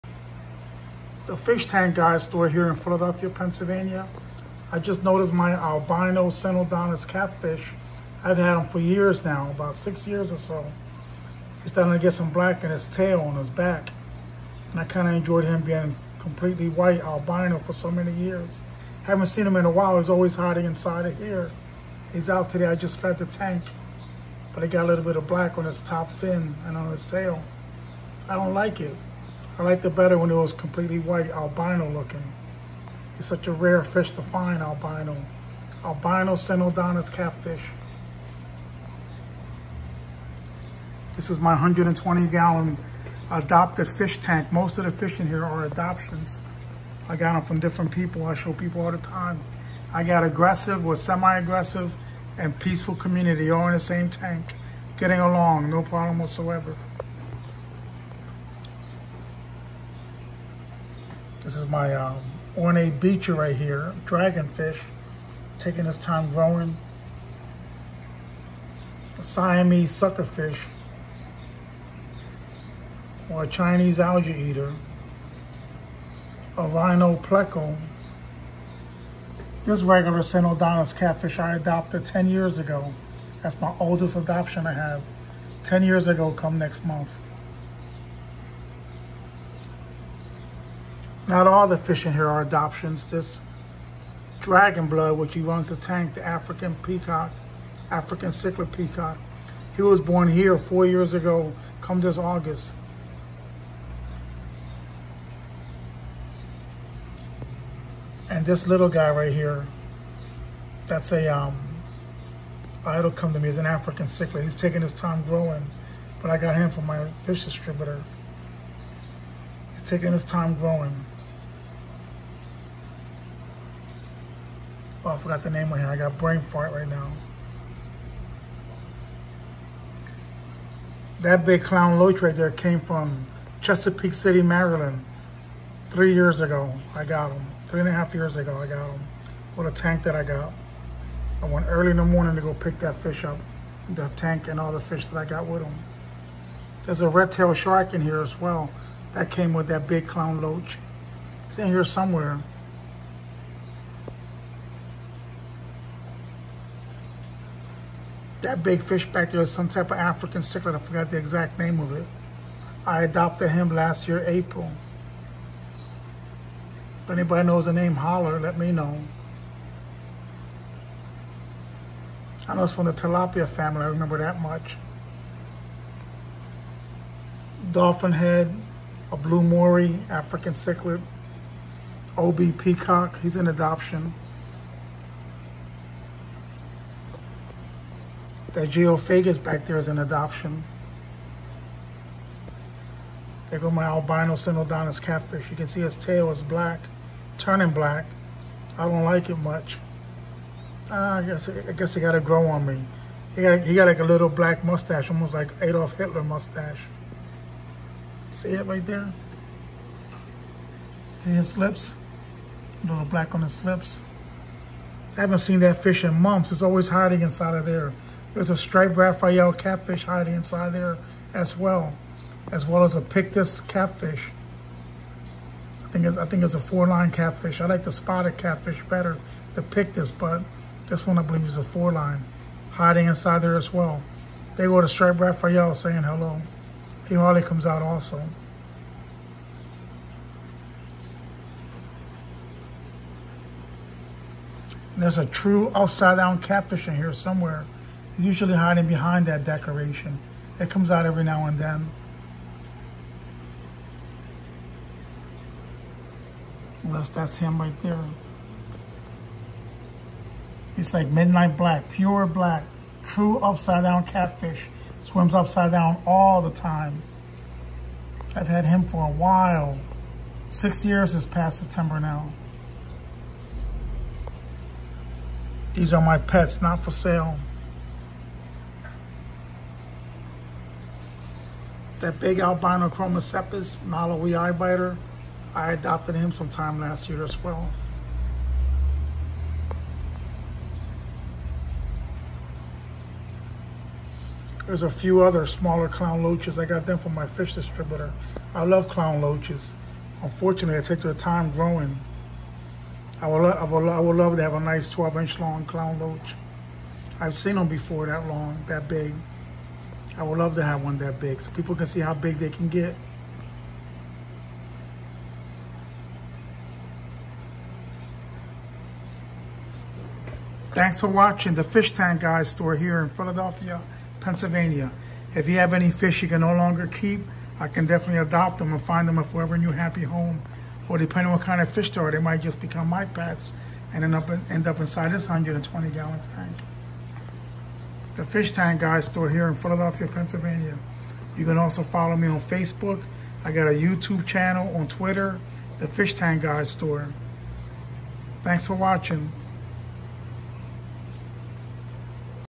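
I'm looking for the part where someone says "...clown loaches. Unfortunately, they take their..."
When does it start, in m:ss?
4:58.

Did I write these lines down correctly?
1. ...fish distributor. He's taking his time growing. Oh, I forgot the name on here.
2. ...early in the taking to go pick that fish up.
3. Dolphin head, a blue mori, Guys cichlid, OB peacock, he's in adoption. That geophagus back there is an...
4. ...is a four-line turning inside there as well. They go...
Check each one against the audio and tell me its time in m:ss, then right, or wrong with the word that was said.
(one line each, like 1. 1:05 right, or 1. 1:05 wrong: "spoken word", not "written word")
1. 1:57 right
2. 2:21 wrong: "morning", not "taking"
3. 2:57 wrong: "African", not "Guys"
4. 3:51 wrong: "hiding", not "turning".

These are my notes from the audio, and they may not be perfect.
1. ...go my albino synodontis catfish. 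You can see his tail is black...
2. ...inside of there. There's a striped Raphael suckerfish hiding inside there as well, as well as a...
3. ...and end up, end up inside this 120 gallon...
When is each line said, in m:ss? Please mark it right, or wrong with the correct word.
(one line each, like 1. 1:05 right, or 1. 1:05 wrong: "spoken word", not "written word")
1. 3:13 right
2. 3:37 wrong: "catfish", not "suckerfish"
3. 5:33 right.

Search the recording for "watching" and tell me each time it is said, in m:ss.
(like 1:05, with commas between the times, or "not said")
5:21, 5:48.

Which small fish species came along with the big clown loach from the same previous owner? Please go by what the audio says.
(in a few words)
Red-tailed shark.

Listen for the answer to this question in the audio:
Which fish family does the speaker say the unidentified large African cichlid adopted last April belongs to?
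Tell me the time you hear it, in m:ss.
2:52.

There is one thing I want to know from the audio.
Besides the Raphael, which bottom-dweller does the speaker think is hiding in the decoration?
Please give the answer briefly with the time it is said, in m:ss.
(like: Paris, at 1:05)
Four-line catfish, at 3:46.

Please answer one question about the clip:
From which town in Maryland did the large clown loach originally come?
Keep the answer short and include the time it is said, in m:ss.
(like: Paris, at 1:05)
Chesapeake City, at 2:13.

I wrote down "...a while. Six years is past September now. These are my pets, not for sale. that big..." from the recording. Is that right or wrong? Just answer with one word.
right.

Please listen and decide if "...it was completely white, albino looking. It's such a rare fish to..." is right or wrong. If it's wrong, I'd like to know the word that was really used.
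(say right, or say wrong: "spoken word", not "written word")
right.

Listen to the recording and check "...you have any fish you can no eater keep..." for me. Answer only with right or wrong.
wrong.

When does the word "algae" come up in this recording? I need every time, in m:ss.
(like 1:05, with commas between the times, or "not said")
1:13.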